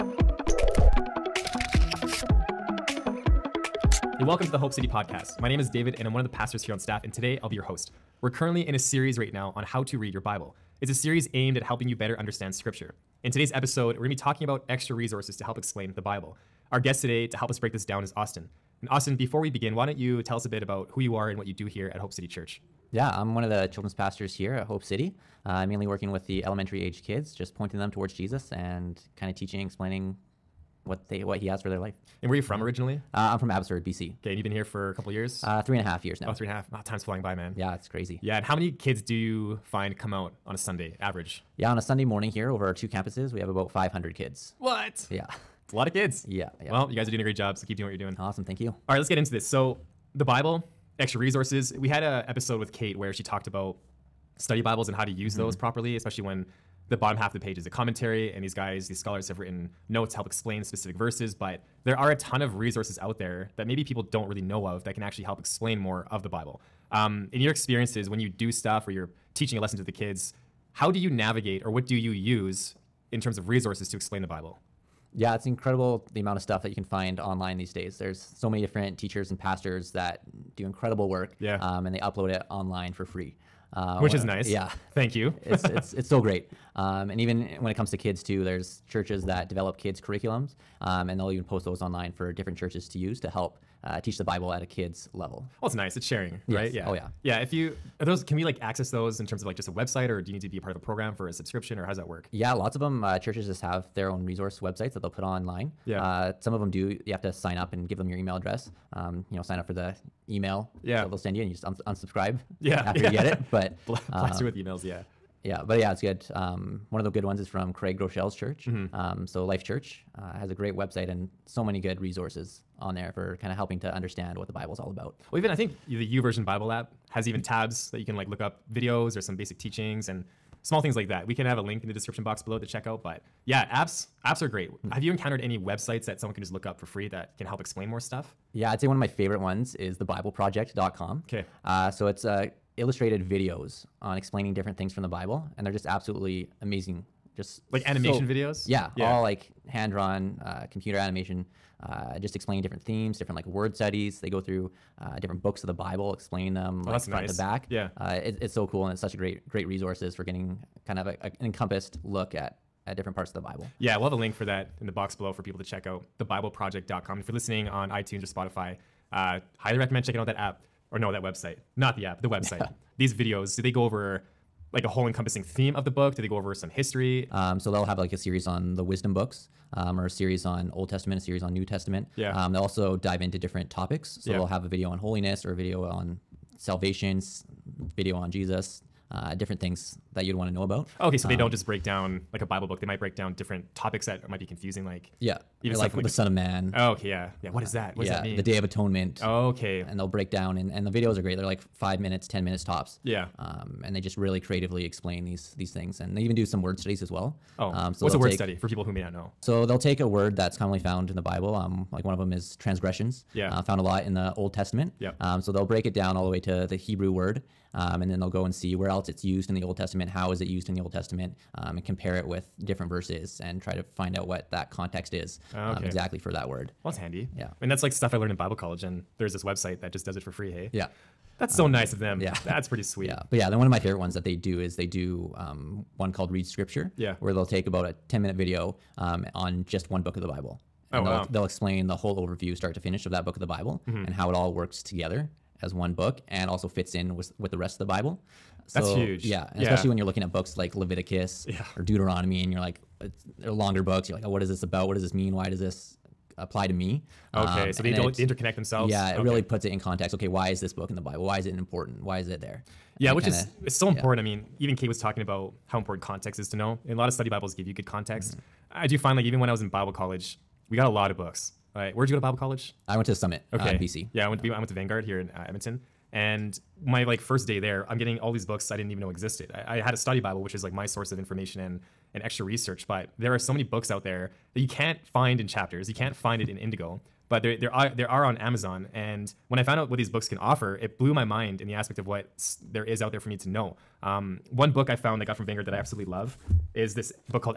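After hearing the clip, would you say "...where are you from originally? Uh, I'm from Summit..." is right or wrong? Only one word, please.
wrong.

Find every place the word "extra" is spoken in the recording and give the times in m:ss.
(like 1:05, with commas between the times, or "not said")
0:14, 0:50, 4:42.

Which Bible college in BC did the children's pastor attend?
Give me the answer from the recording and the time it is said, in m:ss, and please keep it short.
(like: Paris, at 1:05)
Summit, at 4:33.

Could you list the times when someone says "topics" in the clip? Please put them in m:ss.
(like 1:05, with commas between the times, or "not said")
3:03, 3:13.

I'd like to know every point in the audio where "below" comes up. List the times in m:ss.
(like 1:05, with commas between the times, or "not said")
2:12, 2:45.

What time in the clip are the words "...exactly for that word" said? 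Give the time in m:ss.
3:45.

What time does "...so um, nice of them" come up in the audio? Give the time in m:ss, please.
3:51.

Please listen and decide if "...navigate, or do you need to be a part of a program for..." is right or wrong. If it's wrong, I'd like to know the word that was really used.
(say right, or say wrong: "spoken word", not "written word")
wrong: "website", not "navigate".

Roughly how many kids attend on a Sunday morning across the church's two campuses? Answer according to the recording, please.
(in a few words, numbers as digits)
500.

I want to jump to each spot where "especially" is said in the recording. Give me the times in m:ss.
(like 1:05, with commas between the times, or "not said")
0:55, 4:09.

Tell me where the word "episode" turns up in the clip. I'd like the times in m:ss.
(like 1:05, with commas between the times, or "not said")
0:13, 0:52.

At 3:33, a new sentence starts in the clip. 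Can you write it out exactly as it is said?
Yeah, uh, found a lot in the Old Testament.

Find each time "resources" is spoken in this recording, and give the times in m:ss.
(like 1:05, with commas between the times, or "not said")
0:14, 0:51, 1:02, 1:13, 1:44, 2:02, 2:39.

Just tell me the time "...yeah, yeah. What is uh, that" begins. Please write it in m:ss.
3:17.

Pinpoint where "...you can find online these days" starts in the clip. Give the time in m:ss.
1:16.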